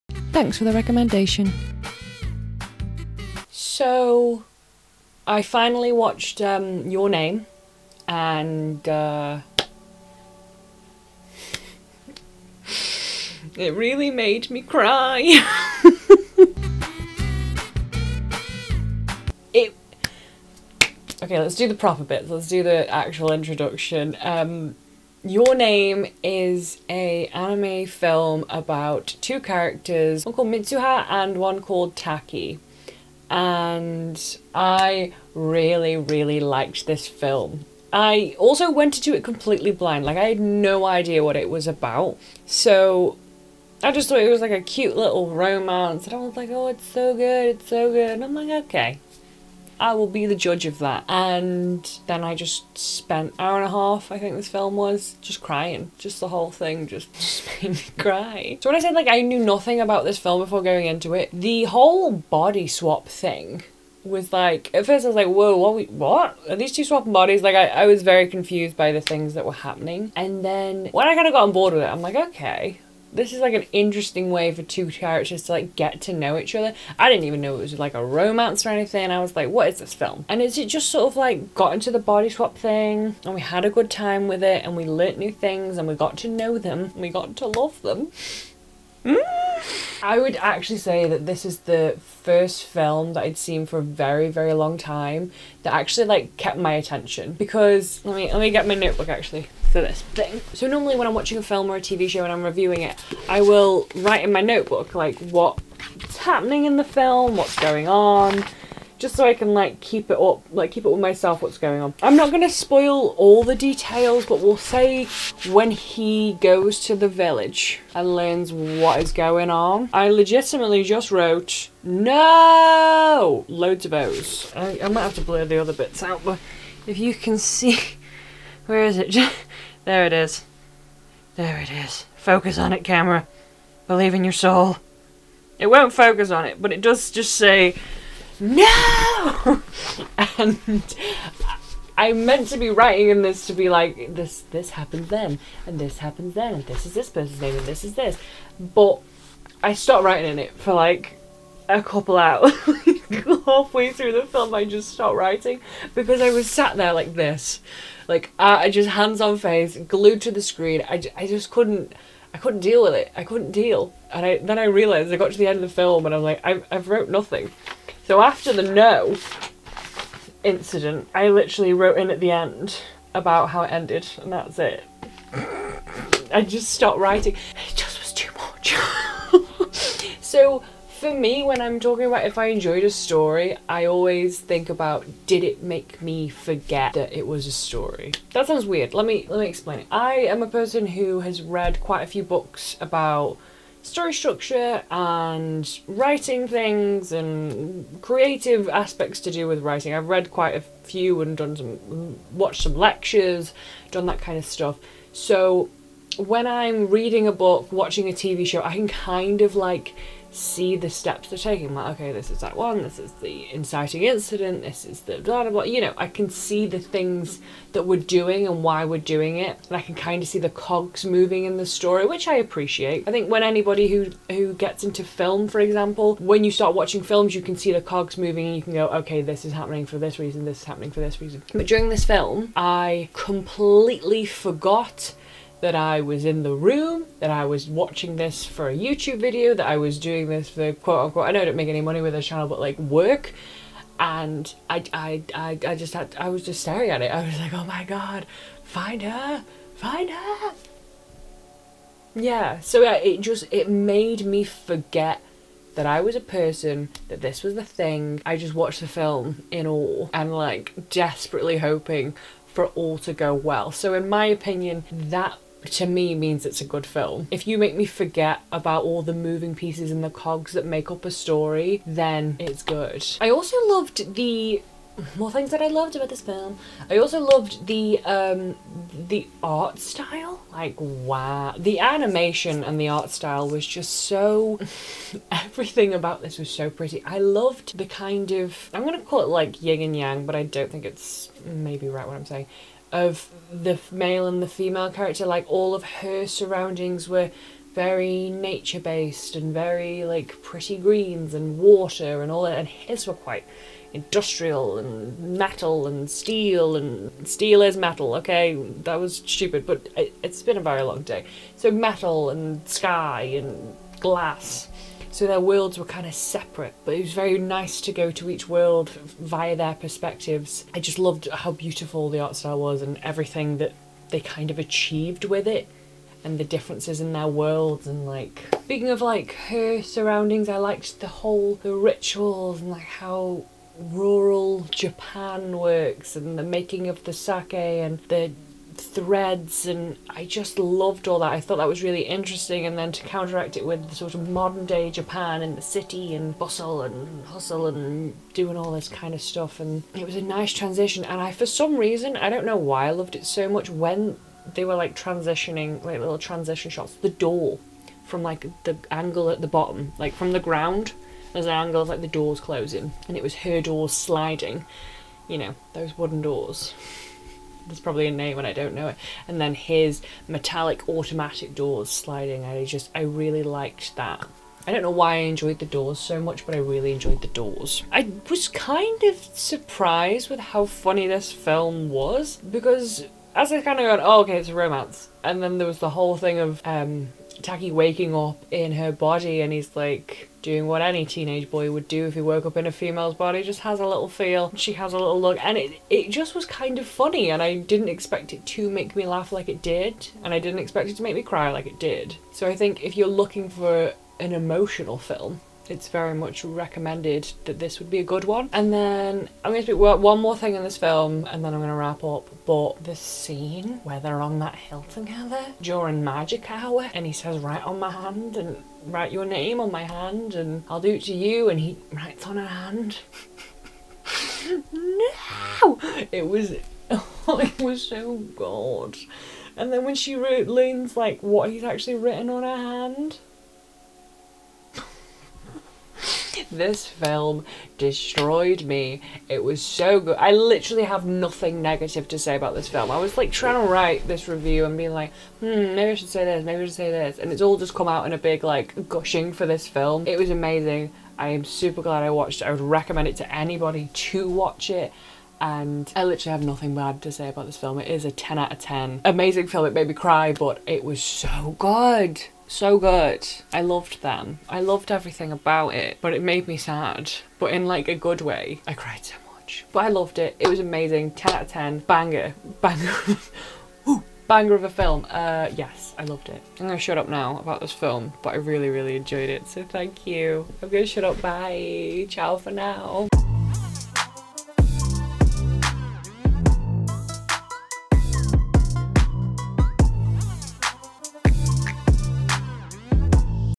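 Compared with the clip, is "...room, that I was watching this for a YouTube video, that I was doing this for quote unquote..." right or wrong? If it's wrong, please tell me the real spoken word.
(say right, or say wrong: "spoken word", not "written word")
right.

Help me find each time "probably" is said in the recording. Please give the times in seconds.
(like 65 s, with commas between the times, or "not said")
367 s.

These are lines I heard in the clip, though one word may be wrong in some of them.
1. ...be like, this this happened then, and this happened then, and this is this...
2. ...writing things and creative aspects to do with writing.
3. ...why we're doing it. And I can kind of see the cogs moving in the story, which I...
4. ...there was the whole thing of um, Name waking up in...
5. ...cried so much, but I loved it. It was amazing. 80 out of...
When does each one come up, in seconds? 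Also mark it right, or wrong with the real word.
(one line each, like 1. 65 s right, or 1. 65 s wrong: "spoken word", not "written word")
1. 143 s right
2. 195 s right
3. 218 s right
4. 385 s wrong: "Taki", not "Name"
5. 468 s wrong: "10", not "80".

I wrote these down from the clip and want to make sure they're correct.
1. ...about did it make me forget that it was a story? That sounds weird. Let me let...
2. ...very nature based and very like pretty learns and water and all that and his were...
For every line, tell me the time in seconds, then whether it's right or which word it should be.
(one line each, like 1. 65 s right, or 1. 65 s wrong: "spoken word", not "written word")
1. 184 s right
2. 297 s wrong: "greens", not "learns".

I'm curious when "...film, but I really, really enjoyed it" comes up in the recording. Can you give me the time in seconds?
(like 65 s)
477 s.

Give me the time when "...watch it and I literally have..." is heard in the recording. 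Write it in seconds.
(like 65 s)
454 s.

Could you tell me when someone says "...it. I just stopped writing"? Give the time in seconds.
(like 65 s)
174 s.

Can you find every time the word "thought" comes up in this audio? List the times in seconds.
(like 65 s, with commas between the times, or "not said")
44 s, 341 s.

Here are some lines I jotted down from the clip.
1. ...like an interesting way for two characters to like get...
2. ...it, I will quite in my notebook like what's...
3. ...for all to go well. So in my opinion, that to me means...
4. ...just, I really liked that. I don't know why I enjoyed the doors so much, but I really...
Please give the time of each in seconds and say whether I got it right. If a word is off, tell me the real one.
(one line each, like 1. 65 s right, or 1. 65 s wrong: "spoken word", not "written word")
1. 73 s right
2. 102 s wrong: "write", not "quite"
3. 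262 s right
4. 372 s right.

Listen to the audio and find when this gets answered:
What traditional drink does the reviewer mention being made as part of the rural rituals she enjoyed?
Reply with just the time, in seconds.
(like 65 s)
337 s.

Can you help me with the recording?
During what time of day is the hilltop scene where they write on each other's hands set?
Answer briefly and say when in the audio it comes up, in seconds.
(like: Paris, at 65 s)
magic hour, at 416 s.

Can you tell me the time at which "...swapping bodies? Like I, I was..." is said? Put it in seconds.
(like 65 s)
66 s.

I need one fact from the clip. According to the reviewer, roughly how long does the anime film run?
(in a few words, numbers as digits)
hour and a half.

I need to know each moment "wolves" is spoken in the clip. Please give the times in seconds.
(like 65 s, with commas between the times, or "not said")
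not said.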